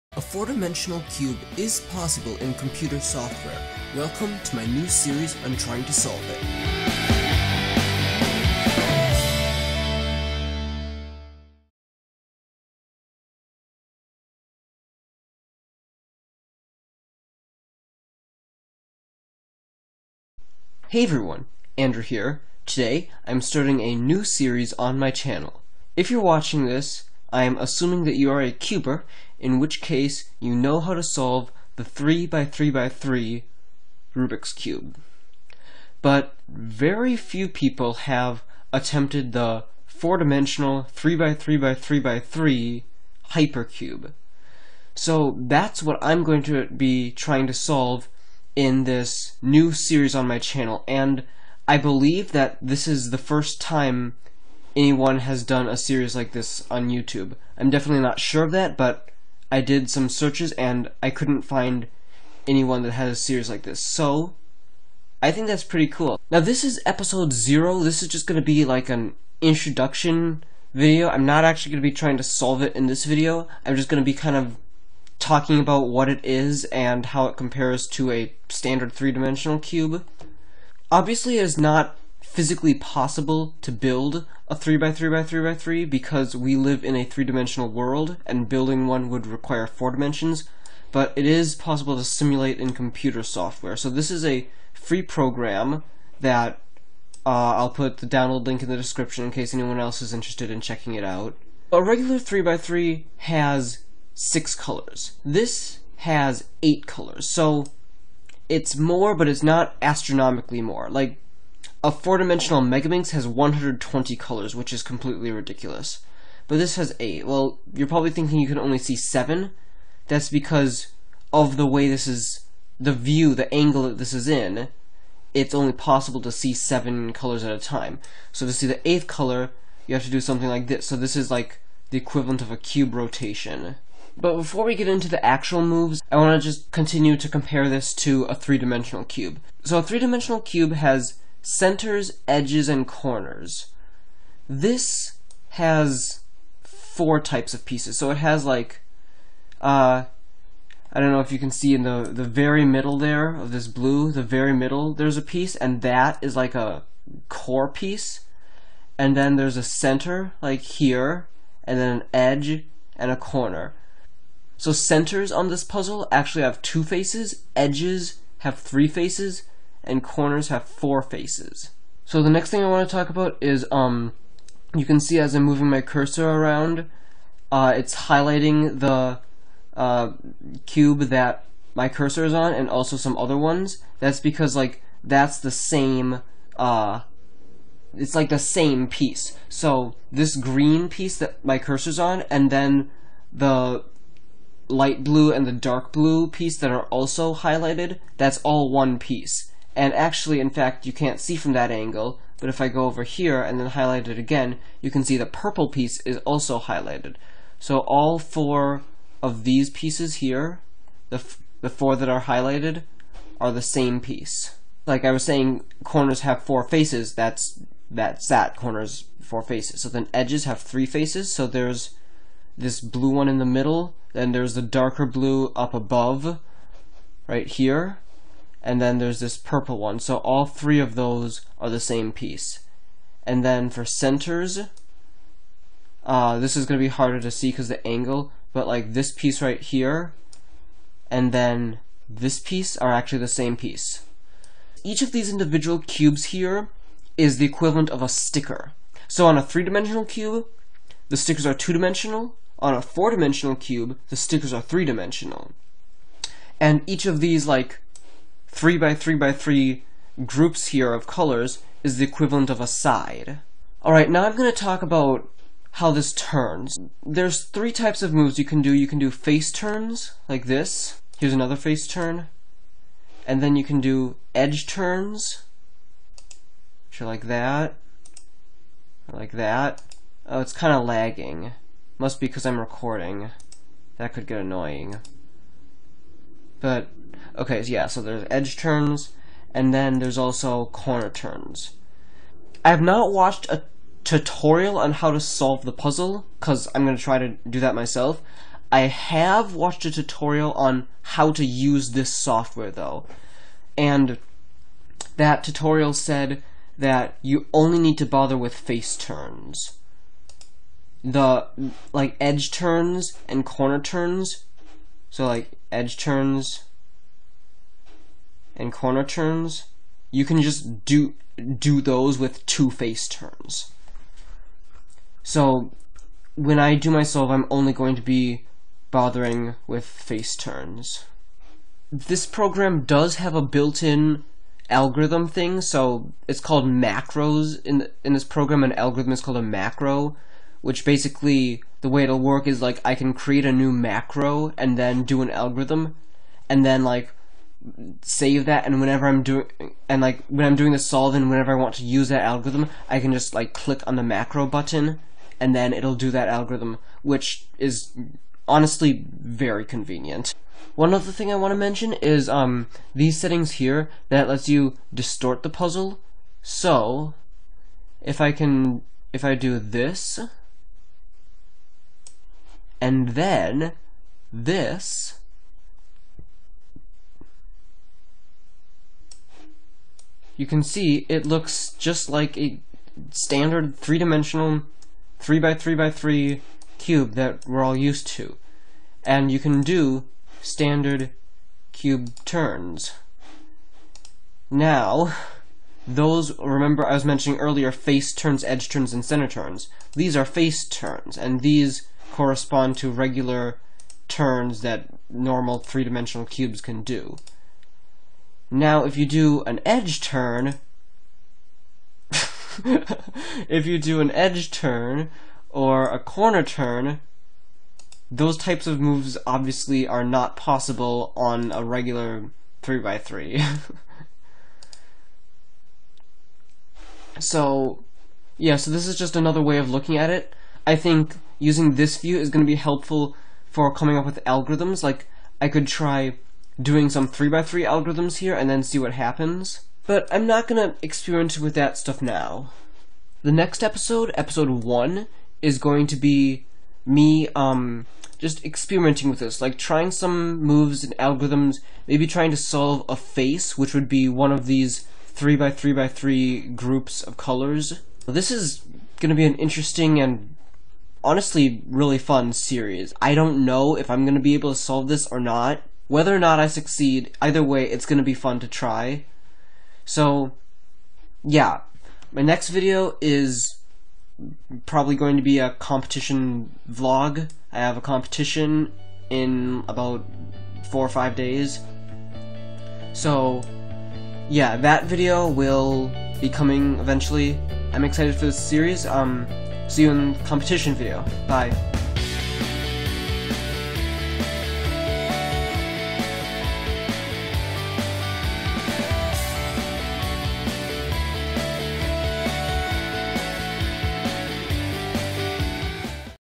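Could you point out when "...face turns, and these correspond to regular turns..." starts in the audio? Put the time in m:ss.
6:40.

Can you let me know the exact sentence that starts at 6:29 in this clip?
And you can do standard cube turns.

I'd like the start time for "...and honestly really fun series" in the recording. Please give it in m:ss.
7:39.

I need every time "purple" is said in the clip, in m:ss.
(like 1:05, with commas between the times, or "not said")
3:25, 3:49.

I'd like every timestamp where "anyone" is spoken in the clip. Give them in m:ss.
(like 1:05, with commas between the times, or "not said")
0:54, 1:02, 1:39.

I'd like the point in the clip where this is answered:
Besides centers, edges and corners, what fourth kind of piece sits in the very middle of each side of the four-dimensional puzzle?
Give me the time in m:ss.
2:37.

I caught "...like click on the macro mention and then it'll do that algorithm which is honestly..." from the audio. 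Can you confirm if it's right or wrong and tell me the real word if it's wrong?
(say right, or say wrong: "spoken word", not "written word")
wrong: "button", not "mention".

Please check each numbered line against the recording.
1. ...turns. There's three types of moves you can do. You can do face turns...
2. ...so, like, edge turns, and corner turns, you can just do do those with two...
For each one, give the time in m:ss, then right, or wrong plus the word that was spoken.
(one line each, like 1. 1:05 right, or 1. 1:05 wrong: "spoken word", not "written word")
1. 4:26 right
2. 5:15 right.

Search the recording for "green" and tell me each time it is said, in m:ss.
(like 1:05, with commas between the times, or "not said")
3:10.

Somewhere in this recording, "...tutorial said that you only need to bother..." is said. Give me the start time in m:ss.
5:05.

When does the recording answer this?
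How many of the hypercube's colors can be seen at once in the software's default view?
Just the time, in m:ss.
2:06.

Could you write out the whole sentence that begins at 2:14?
But before we get into the actual moves, I want to just continue to compare this to a three-dimensional cube.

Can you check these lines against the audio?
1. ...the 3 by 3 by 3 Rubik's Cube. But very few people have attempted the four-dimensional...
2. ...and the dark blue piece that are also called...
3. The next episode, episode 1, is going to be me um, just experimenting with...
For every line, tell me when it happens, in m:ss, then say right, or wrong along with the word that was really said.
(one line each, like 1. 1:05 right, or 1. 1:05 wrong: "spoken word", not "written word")
1. 0:31 right
2. 3:15 wrong: "highlighted", not "called"
3. 7:23 right.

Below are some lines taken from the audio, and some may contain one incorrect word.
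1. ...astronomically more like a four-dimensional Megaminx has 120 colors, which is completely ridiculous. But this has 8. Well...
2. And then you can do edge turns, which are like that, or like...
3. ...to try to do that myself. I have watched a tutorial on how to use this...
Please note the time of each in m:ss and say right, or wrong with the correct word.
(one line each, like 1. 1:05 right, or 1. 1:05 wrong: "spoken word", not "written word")
1. 1:49 right
2. 4:33 right
3. 4:56 right.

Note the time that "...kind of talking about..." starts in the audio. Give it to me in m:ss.
1:14.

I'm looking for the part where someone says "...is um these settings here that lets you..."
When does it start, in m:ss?
6:01.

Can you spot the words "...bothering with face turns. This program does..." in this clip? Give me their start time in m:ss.
5:28.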